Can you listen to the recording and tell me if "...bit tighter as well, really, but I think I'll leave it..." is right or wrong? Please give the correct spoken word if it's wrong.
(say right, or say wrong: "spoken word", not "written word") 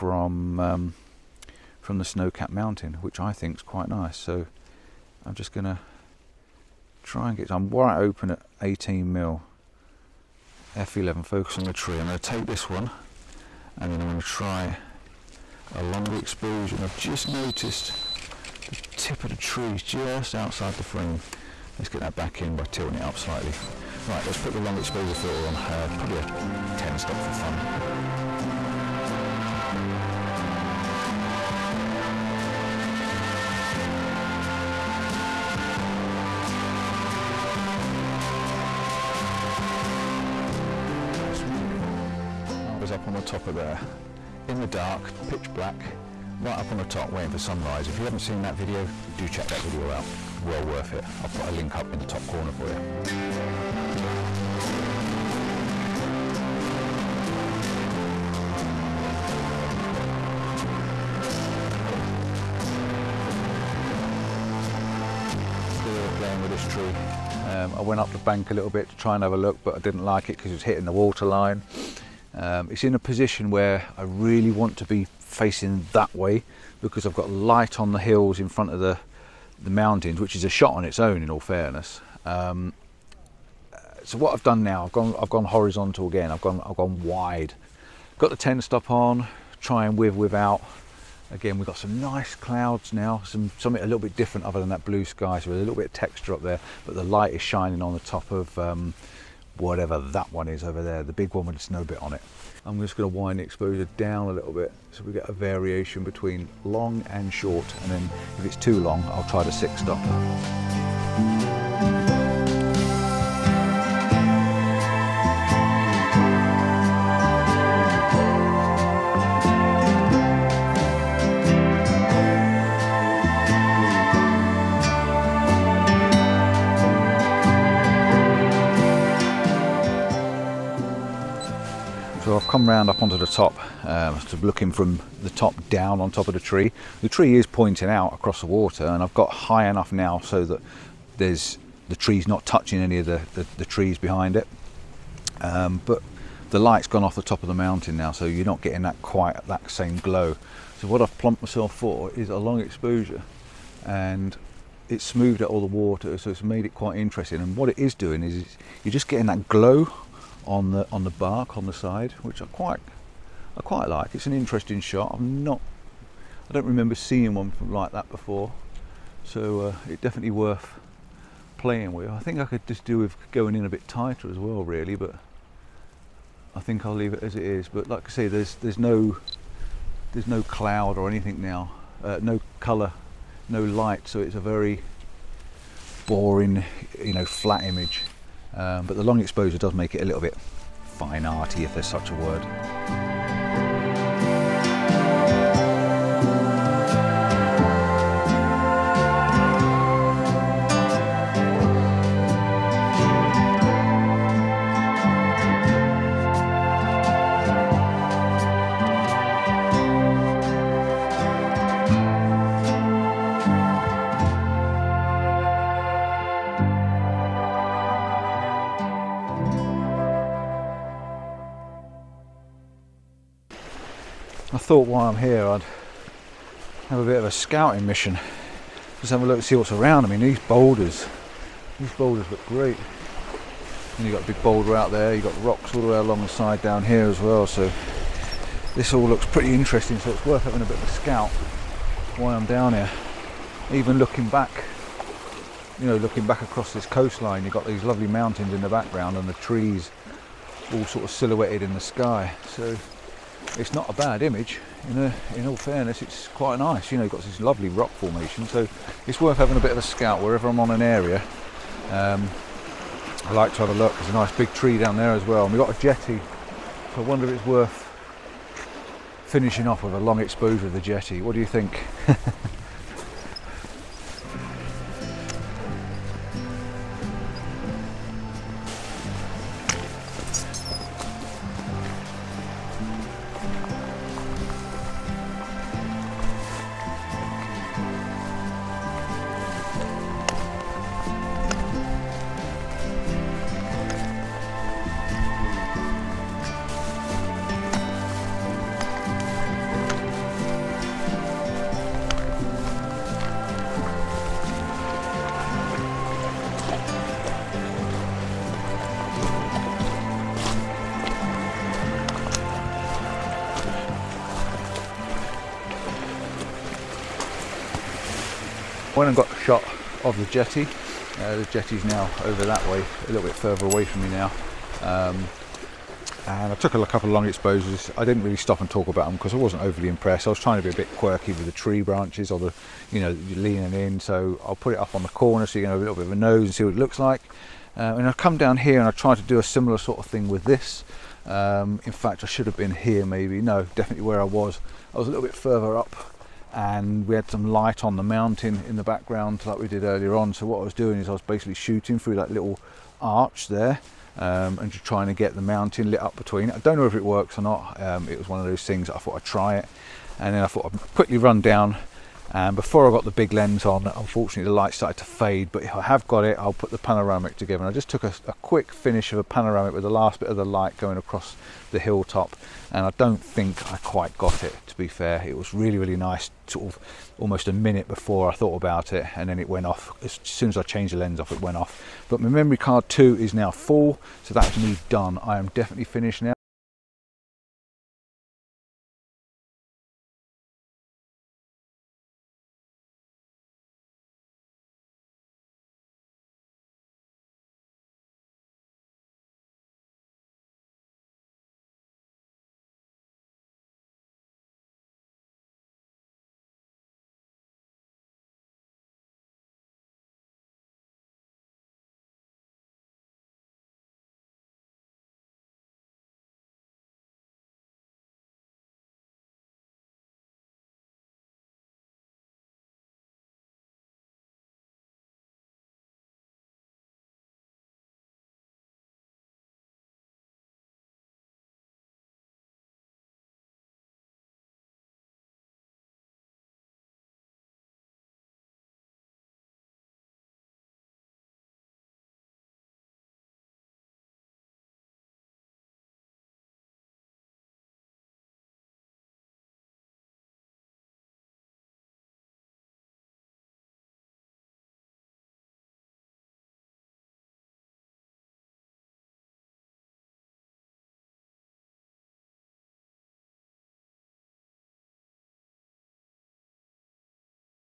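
right.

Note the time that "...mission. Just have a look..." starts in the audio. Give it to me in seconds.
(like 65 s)
227 s.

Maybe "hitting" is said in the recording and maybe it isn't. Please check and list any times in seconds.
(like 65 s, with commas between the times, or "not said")
70 s.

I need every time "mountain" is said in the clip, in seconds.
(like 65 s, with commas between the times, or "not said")
2 s, 79 s, 147 s, 248 s, 348 s, 355 s.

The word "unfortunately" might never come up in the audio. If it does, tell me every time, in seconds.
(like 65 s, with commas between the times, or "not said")
363 s.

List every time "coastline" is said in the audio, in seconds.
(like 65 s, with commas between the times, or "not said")
246 s.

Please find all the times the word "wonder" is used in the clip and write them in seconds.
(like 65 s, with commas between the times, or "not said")
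267 s.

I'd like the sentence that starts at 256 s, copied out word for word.
You know, you've got this lovely rock formation, so it's worth having a bit of a scout wherever I'm on an area.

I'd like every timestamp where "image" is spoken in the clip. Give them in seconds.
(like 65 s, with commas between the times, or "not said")
187 s, 254 s.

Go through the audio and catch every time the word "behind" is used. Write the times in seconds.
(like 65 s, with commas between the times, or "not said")
143 s.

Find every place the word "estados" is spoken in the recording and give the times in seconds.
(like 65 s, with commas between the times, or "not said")
not said.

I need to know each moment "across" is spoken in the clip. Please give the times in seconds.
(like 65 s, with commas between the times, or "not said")
138 s, 246 s, 370 s.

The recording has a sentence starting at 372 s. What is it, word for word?
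And I don't think I quite got it, to be fair.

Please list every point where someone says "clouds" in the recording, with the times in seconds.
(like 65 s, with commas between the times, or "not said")
92 s, 180 s.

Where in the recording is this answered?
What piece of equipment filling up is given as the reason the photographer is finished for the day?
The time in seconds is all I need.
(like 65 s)
382 s.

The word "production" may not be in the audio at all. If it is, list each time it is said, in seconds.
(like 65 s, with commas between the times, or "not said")
not said.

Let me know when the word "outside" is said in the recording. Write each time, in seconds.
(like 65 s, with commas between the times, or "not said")
20 s.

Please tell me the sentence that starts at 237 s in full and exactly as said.
So this all looks pretty interesting.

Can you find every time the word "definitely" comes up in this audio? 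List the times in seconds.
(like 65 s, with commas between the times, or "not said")
170 s, 343 s, 385 s.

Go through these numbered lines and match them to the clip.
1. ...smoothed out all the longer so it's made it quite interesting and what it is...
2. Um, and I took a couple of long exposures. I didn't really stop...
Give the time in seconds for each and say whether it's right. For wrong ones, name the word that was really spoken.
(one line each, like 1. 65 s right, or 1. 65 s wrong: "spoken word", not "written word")
1. 155 s wrong: "water", not "longer"
2. 324 s right.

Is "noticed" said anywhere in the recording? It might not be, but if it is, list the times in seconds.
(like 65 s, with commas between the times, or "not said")
17 s.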